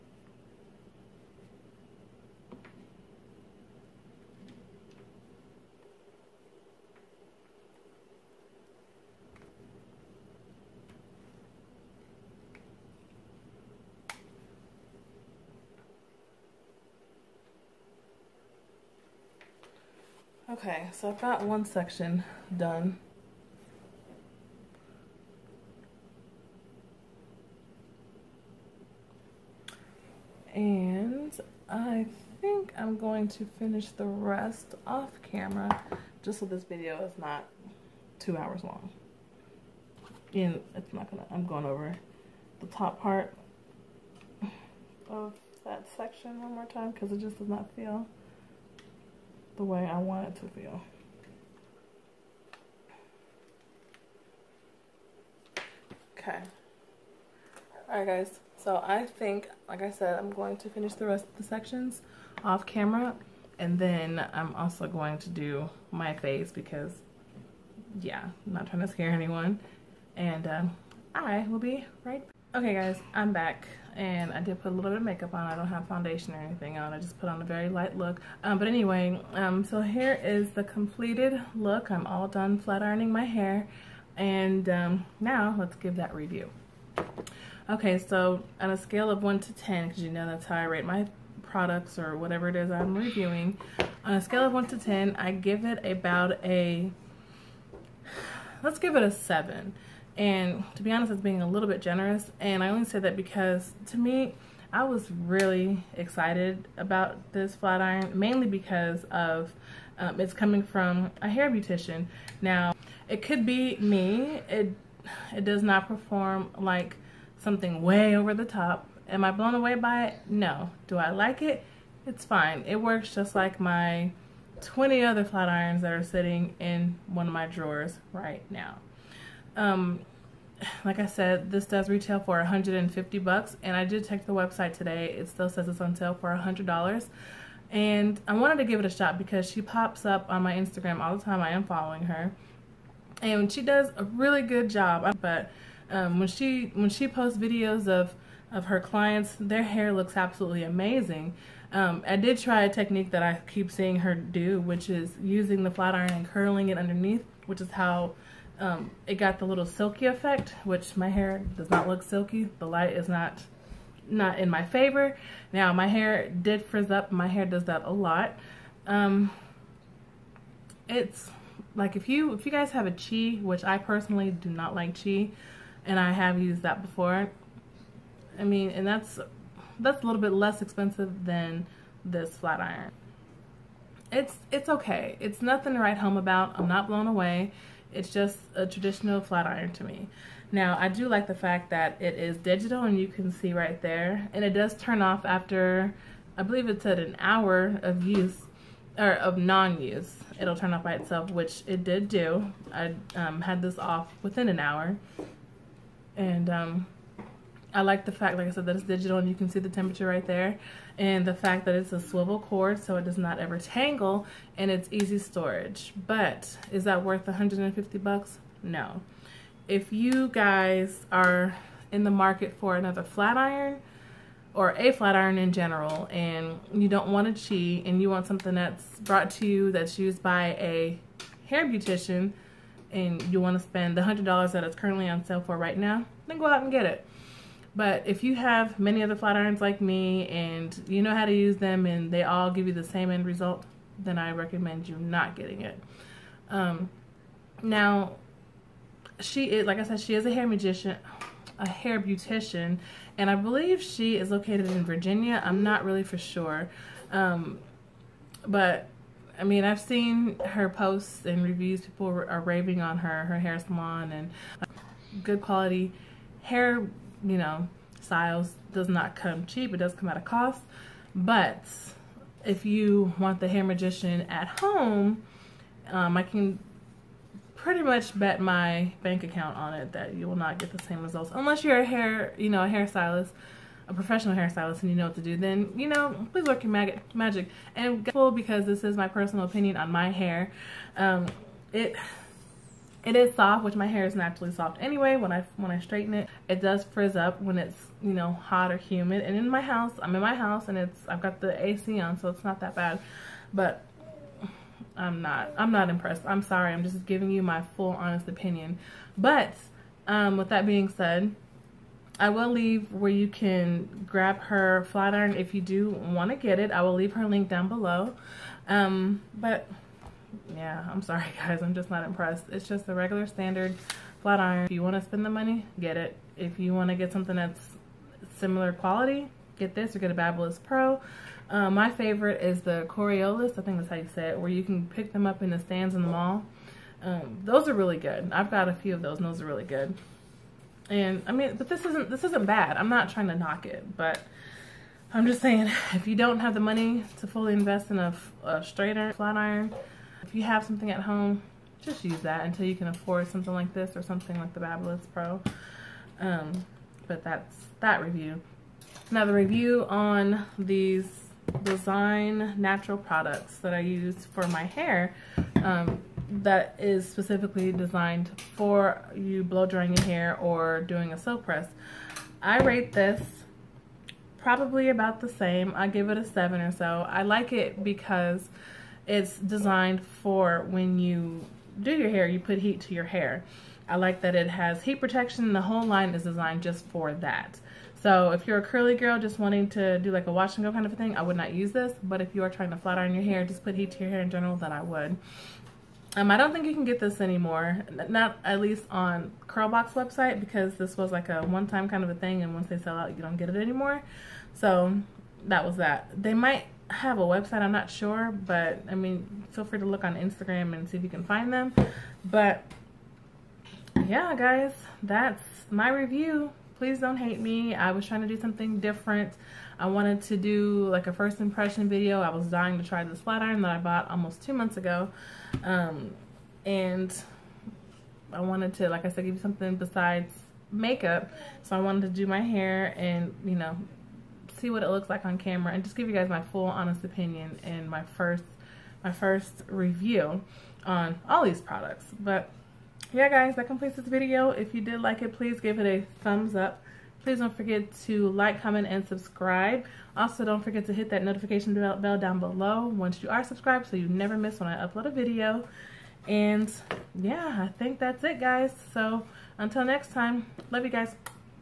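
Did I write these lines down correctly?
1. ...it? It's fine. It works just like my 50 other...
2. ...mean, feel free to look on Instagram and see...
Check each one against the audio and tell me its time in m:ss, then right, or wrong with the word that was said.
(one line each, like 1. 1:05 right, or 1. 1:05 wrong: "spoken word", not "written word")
1. 2:01 wrong: "20", not "50"
2. 6:48 right.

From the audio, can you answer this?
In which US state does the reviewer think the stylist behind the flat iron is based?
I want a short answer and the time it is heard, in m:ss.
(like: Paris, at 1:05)
Virginia, at 4:14.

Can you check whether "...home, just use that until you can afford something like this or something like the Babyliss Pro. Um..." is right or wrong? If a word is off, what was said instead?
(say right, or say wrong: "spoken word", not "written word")
right.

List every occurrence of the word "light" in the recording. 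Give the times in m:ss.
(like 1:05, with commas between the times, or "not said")
1:17, 2:42.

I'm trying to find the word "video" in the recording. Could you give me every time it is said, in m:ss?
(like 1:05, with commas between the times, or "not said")
0:36, 2:27, 7:01, 7:24, 7:35.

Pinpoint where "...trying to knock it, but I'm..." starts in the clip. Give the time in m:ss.
5:43.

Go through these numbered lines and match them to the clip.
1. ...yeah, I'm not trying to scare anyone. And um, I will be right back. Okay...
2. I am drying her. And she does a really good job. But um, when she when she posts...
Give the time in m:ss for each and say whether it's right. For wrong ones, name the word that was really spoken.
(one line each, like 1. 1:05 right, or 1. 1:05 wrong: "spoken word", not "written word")
1. 1:08 right
2. 2:21 wrong: "following", not "drying".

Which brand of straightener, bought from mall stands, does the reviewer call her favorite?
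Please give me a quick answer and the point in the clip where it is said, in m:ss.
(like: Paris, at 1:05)
Corioliss, at 5:32.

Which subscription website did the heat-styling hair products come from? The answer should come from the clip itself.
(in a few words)
Curlbox.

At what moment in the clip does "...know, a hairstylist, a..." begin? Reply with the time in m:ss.
4:42.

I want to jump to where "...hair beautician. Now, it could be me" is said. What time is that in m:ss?
1:51.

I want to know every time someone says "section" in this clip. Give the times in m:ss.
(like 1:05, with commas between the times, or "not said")
0:21, 0:45, 1:01.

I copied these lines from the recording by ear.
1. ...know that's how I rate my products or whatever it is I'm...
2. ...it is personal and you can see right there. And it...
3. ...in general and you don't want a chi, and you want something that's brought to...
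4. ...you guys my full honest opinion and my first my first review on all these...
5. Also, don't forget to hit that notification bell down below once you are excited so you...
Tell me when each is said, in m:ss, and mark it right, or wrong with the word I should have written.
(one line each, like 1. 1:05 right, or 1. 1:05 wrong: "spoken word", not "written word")
1. 1:30 right
2. 3:11 wrong: "digital", not "personal"
3. 3:45 right
4. 7:16 right
5. 7:30 wrong: "subscribed", not "excited".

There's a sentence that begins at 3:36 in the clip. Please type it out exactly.
But is that worth 150 bucks?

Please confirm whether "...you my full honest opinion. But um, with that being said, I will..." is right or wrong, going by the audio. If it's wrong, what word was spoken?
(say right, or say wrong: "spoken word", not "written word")
right.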